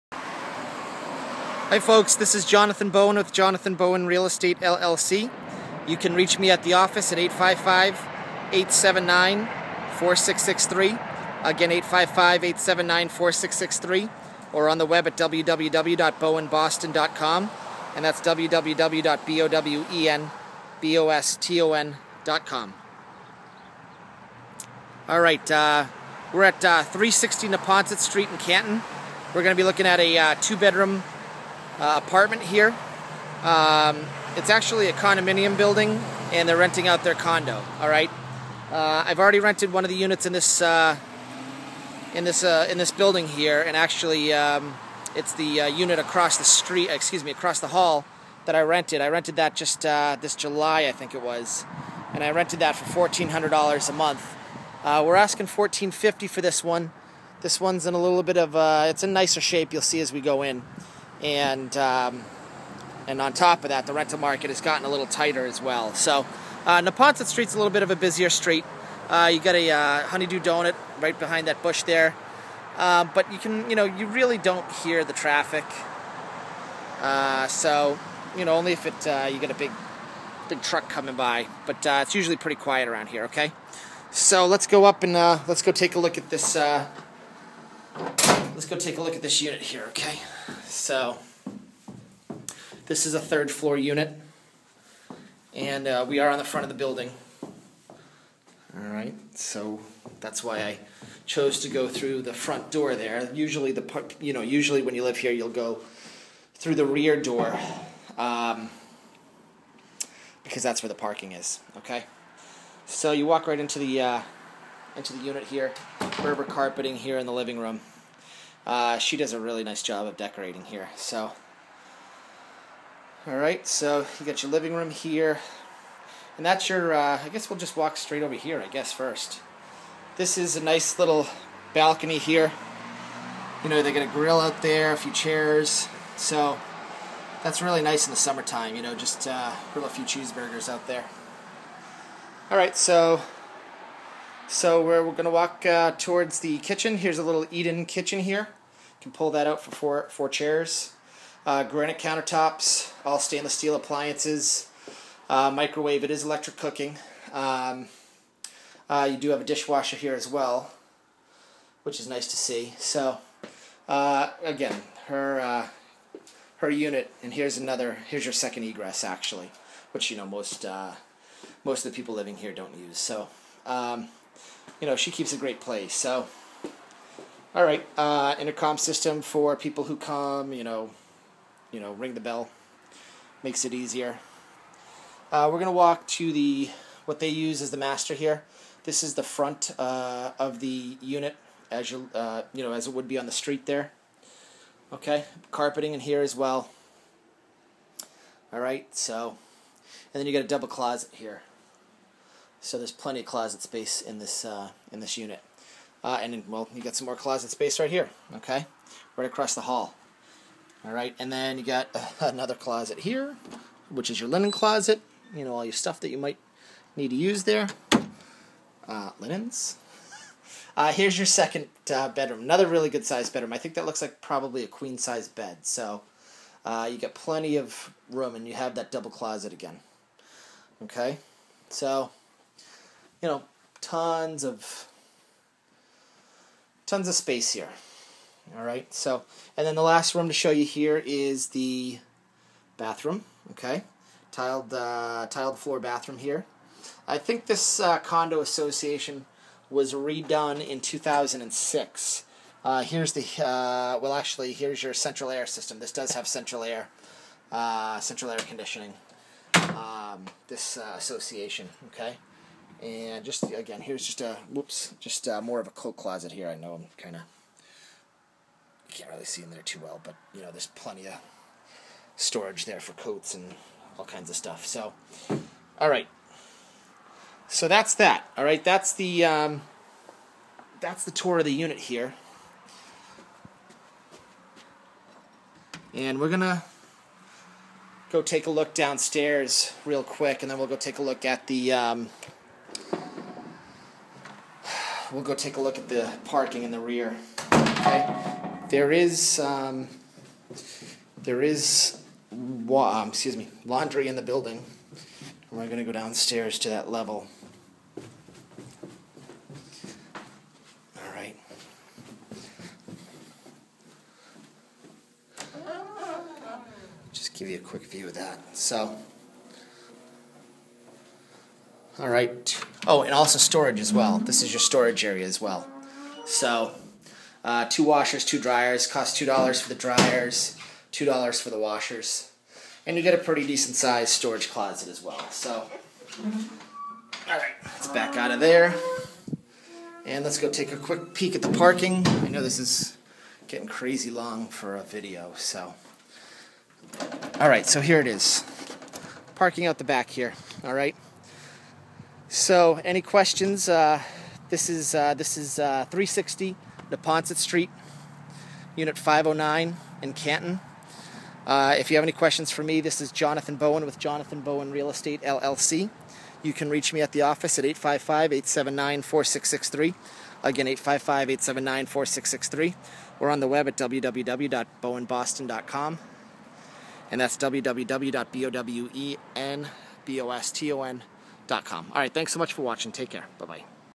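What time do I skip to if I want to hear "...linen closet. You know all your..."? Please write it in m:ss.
3:34.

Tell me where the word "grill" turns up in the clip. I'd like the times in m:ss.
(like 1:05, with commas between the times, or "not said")
2:14, 2:19.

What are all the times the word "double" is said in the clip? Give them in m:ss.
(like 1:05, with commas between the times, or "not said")
3:20, 3:48.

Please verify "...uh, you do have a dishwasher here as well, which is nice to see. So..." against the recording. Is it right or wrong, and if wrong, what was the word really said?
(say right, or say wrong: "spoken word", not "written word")
right.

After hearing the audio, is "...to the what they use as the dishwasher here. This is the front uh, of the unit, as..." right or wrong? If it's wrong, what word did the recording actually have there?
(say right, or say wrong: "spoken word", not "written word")
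wrong: "master", not "dishwasher".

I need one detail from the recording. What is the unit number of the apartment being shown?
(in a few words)
509.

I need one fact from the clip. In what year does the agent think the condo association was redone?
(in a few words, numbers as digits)
2006.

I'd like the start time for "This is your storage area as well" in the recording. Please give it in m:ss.
5:24.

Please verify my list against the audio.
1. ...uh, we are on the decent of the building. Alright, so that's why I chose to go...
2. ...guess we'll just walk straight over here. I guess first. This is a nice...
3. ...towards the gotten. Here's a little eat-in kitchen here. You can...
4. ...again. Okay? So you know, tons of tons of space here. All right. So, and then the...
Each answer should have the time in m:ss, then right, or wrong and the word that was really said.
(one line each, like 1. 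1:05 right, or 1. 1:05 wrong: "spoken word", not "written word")
1. 1:35 wrong: "front", not "decent"
2. 2:07 right
3. 2:25 wrong: "kitchen", not "gotten"
4. 3:49 right.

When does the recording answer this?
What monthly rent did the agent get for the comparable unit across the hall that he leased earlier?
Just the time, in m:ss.
0:52.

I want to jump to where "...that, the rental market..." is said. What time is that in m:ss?
1:03.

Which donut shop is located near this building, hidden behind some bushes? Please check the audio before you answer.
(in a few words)
Honey Dew Donut.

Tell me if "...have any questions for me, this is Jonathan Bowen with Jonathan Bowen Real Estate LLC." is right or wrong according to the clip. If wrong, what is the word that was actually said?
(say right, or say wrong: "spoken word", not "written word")
right.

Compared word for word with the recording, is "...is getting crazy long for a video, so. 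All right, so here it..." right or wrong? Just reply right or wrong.
right.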